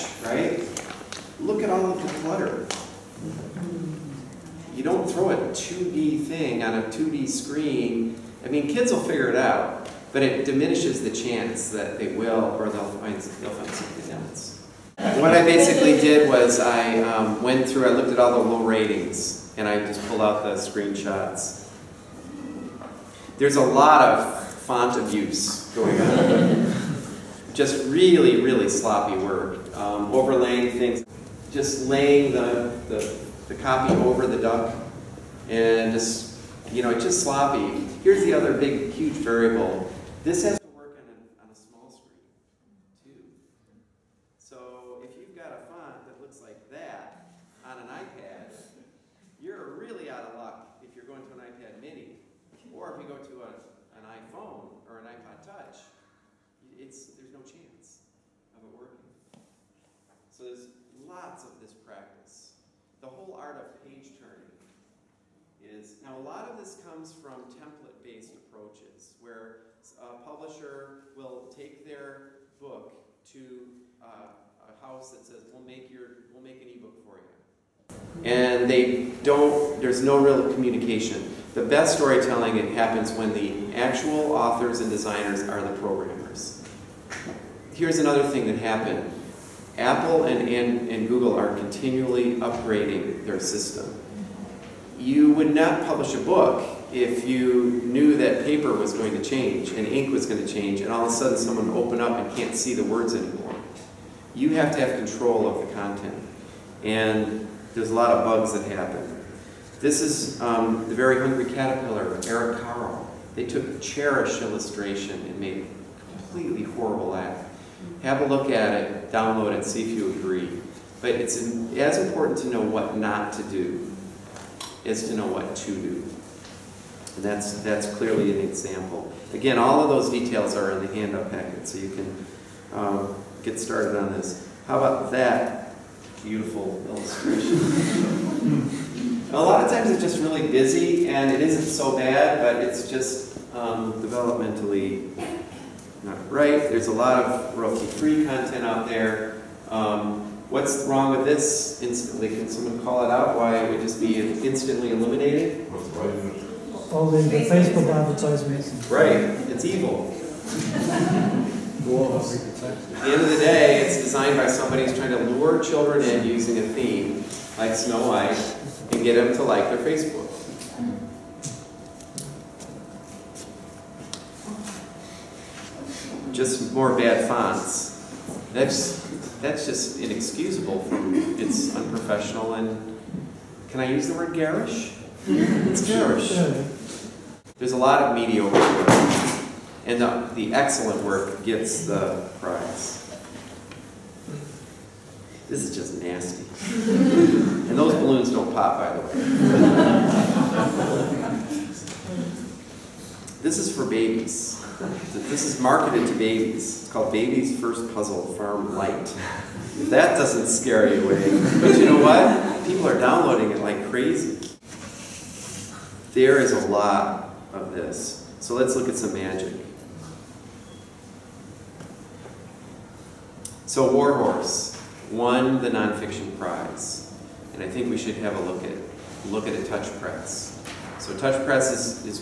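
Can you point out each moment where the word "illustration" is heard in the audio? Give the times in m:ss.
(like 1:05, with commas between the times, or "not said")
1:54, 2:16.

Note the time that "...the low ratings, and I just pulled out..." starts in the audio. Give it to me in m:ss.
0:18.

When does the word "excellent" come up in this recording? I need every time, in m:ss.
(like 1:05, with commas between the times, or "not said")
3:10.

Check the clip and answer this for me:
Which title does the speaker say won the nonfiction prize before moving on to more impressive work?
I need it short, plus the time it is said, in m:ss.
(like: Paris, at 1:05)
War Horse, at 3:43.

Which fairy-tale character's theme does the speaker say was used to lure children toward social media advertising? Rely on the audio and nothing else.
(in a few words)
Snow White.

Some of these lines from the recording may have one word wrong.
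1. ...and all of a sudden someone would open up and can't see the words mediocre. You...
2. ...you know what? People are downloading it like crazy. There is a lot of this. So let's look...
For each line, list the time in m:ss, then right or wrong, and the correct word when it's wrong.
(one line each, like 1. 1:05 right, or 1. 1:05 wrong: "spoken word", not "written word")
1. 1:40 wrong: "anymore", not "mediocre"
2. 3:31 right.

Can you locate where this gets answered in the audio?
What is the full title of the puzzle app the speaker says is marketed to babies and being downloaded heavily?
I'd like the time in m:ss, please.
3:27.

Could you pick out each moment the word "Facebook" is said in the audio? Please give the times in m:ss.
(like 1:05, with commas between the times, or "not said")
2:37, 2:49.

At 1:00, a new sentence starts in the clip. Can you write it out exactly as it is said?
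So there's lots of this practice.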